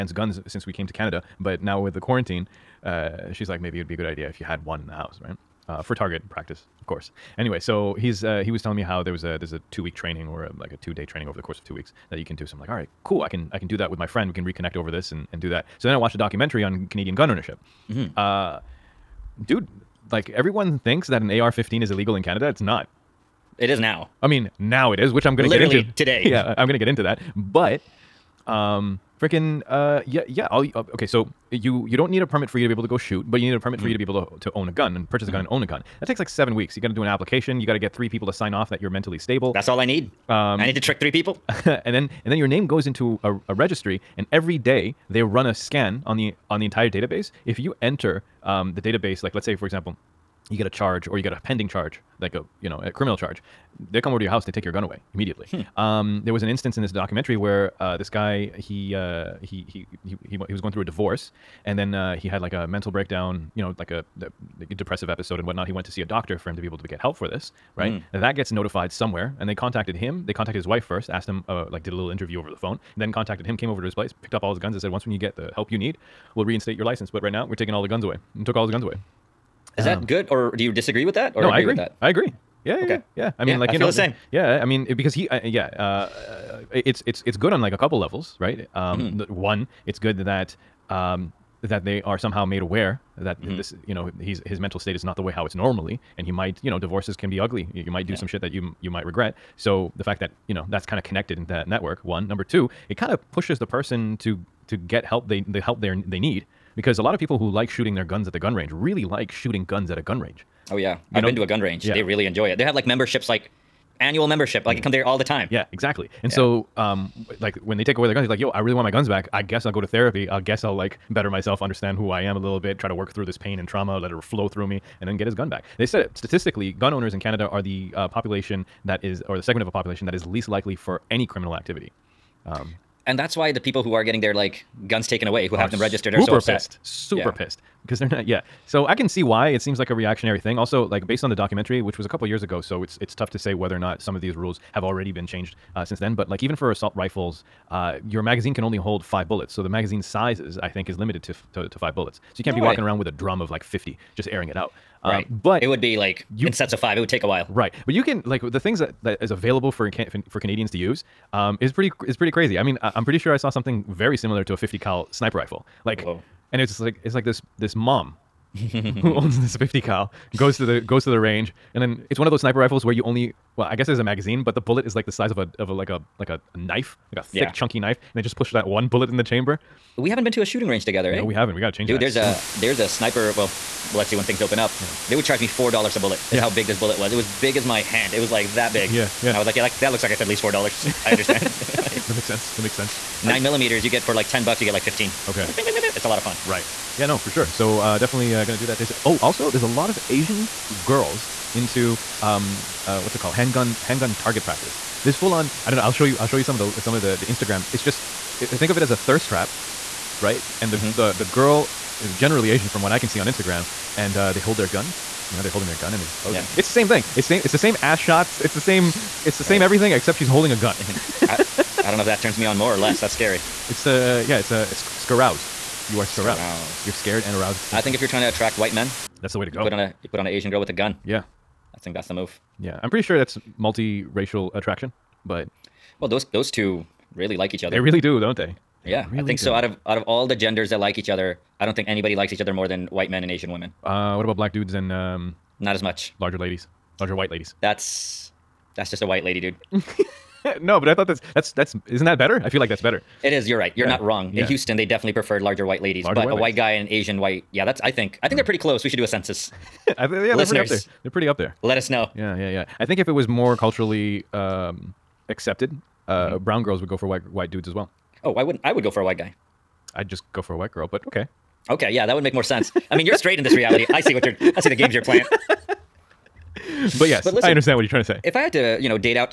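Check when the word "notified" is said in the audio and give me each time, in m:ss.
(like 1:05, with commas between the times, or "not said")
1:08.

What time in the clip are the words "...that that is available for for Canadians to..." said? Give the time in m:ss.
2:38.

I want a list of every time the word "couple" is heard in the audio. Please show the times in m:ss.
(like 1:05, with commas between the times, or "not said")
1:27, 2:22.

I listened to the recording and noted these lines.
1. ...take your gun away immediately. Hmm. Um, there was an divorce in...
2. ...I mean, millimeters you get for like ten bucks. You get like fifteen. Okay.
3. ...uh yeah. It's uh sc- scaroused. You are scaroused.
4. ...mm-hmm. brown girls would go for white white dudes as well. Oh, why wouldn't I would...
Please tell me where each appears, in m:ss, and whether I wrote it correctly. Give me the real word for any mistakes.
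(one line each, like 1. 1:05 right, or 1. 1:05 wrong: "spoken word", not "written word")
1. 0:54 wrong: "instance", not "divorce"
2. 3:13 right
3. 3:43 right
4. 4:26 right.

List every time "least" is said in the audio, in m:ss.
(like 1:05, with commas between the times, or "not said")
2:10, 3:10.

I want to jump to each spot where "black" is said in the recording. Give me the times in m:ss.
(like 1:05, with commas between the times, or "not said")
4:04.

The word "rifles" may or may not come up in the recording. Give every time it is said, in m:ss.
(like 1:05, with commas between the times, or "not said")
2:26, 2:45, 2:52.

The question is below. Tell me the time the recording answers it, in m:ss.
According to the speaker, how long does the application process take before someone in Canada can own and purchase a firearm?
0:36.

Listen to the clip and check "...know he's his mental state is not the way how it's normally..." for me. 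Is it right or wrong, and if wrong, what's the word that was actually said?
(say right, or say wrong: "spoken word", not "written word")
right.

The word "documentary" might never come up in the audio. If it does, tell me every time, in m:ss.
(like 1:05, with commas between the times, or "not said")
0:16, 0:56, 2:21.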